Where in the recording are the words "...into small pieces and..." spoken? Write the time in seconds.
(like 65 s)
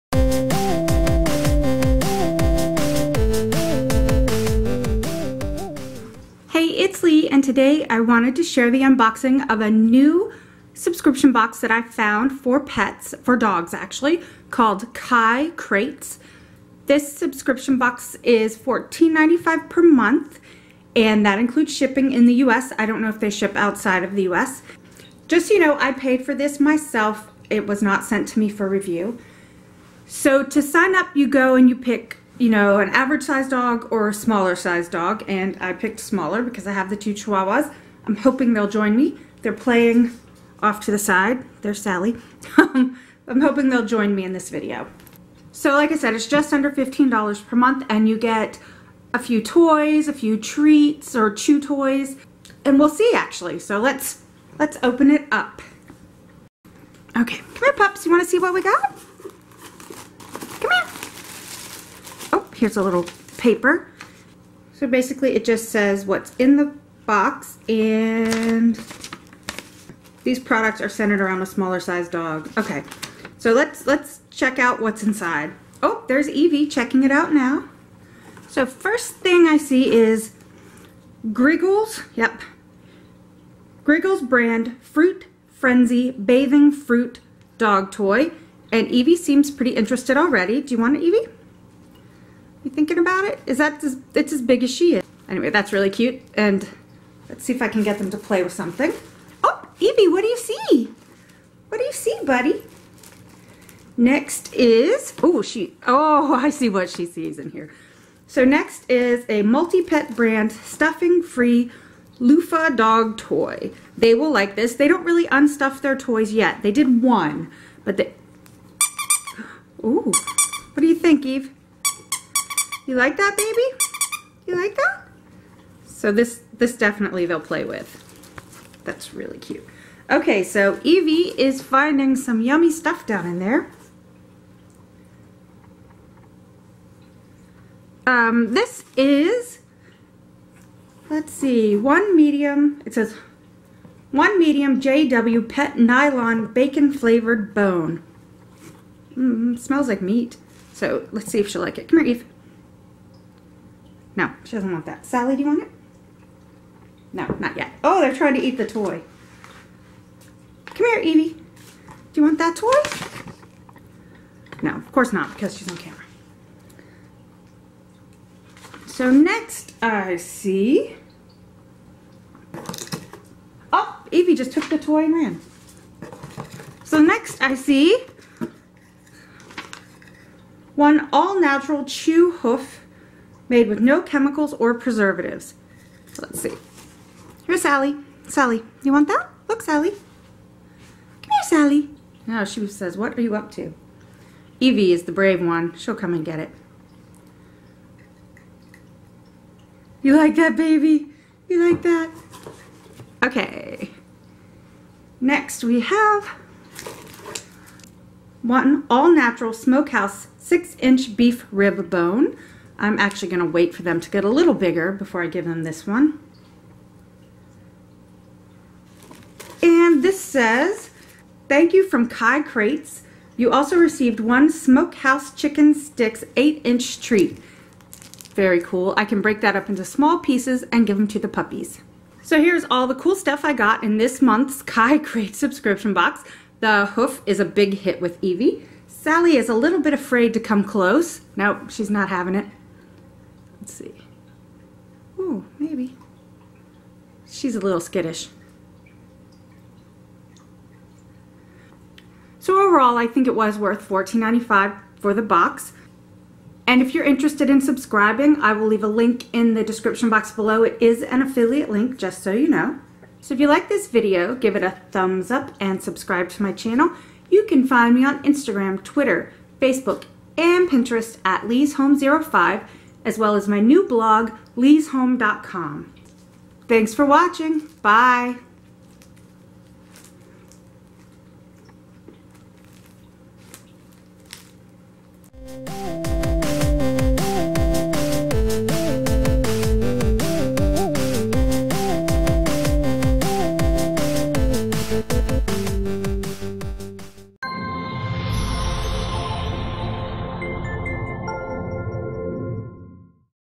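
229 s.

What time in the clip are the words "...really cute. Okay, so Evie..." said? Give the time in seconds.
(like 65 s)
129 s.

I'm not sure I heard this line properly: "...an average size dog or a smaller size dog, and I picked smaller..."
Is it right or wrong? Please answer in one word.
right.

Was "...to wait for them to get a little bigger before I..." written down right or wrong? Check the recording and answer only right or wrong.
right.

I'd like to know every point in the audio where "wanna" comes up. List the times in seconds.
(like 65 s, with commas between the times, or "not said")
58 s.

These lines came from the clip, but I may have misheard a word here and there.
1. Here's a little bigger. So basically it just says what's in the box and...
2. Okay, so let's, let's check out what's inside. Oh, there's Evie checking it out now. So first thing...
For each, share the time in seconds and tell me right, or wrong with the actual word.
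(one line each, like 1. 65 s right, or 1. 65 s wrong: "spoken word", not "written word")
1. 62 s wrong: "paper", not "bigger"
2. 72 s right.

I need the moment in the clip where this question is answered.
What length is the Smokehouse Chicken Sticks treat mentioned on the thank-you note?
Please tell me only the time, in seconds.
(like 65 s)
226 s.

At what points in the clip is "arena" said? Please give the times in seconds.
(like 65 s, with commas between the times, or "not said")
not said.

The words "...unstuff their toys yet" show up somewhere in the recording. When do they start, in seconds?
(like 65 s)
115 s.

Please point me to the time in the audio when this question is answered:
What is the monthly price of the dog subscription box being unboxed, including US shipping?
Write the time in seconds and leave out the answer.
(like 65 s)
18 s.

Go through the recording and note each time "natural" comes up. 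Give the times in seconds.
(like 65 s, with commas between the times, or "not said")
181 s, 208 s.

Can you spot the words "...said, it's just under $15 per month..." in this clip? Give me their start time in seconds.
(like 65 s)
45 s.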